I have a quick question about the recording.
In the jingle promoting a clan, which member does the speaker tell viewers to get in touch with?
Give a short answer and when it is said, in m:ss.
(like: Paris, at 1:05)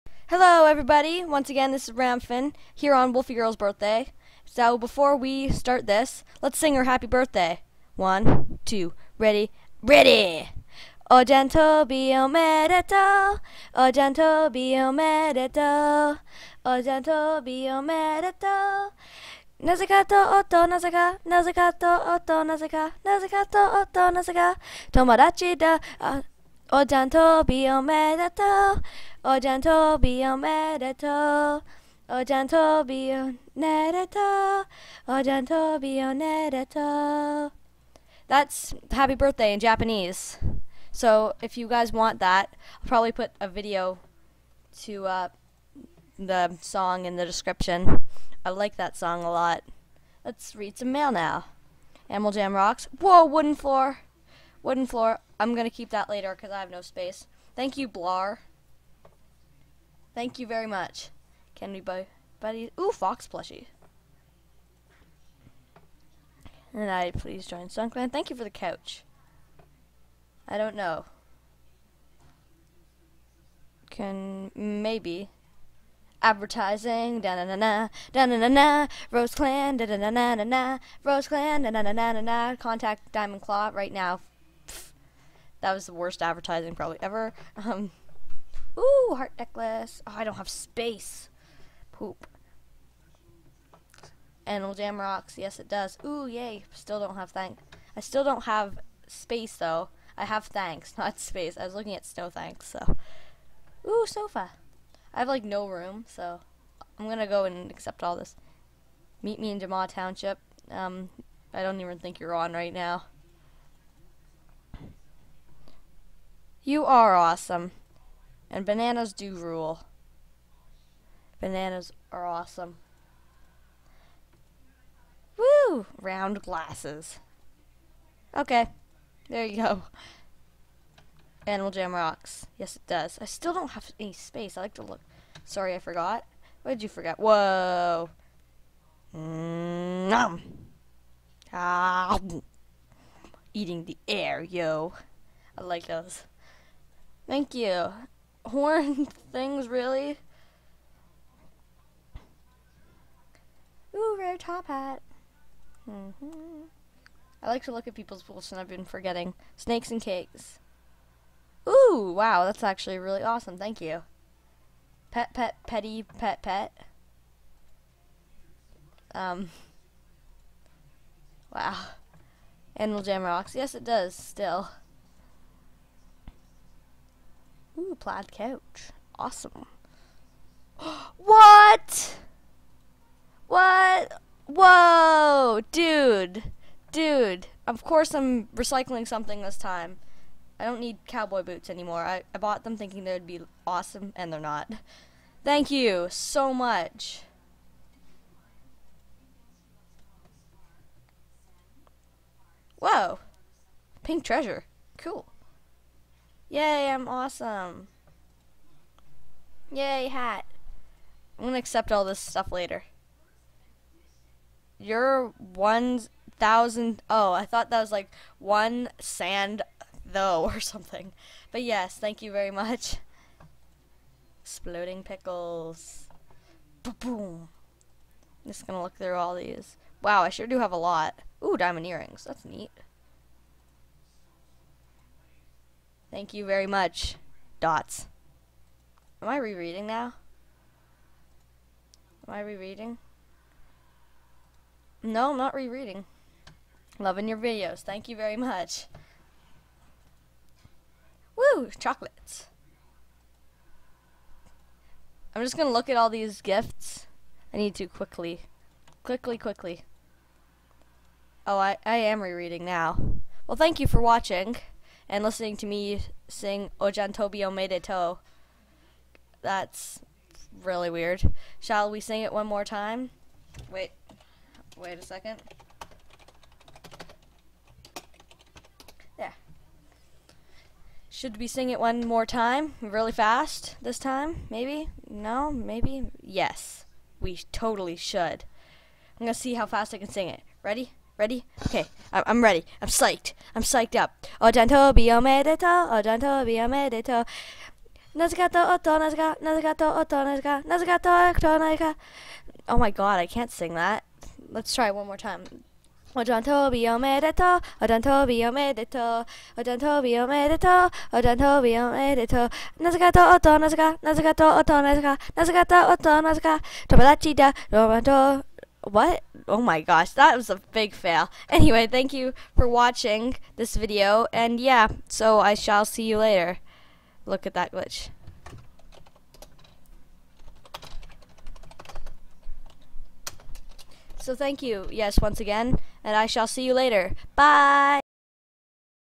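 Diamond Claw, at 1:23.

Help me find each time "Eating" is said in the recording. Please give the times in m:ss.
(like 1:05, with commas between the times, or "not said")
2:23.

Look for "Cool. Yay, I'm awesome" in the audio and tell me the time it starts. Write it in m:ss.
3:24.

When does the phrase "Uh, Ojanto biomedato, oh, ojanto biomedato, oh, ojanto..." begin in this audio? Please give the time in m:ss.
0:25.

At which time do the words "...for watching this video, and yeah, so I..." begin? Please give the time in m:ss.
5:22.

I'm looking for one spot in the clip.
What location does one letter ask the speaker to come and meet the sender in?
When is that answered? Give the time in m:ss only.
1:49.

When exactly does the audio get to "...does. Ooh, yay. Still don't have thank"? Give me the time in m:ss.
1:35.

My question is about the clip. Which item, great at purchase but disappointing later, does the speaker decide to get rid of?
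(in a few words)
cowboy boots.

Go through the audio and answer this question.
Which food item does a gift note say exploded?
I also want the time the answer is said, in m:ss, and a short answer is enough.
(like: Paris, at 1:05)
pickles, at 3:44.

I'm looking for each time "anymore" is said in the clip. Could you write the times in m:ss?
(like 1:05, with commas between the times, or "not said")
3:11.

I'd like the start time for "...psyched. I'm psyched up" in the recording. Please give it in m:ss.
4:52.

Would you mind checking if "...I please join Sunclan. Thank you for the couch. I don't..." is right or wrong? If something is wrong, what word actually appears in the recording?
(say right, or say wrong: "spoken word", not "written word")
right.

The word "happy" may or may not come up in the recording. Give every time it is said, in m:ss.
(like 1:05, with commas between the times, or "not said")
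0:06, 0:38.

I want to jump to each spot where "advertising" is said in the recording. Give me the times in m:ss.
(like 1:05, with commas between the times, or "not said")
1:16, 1:26.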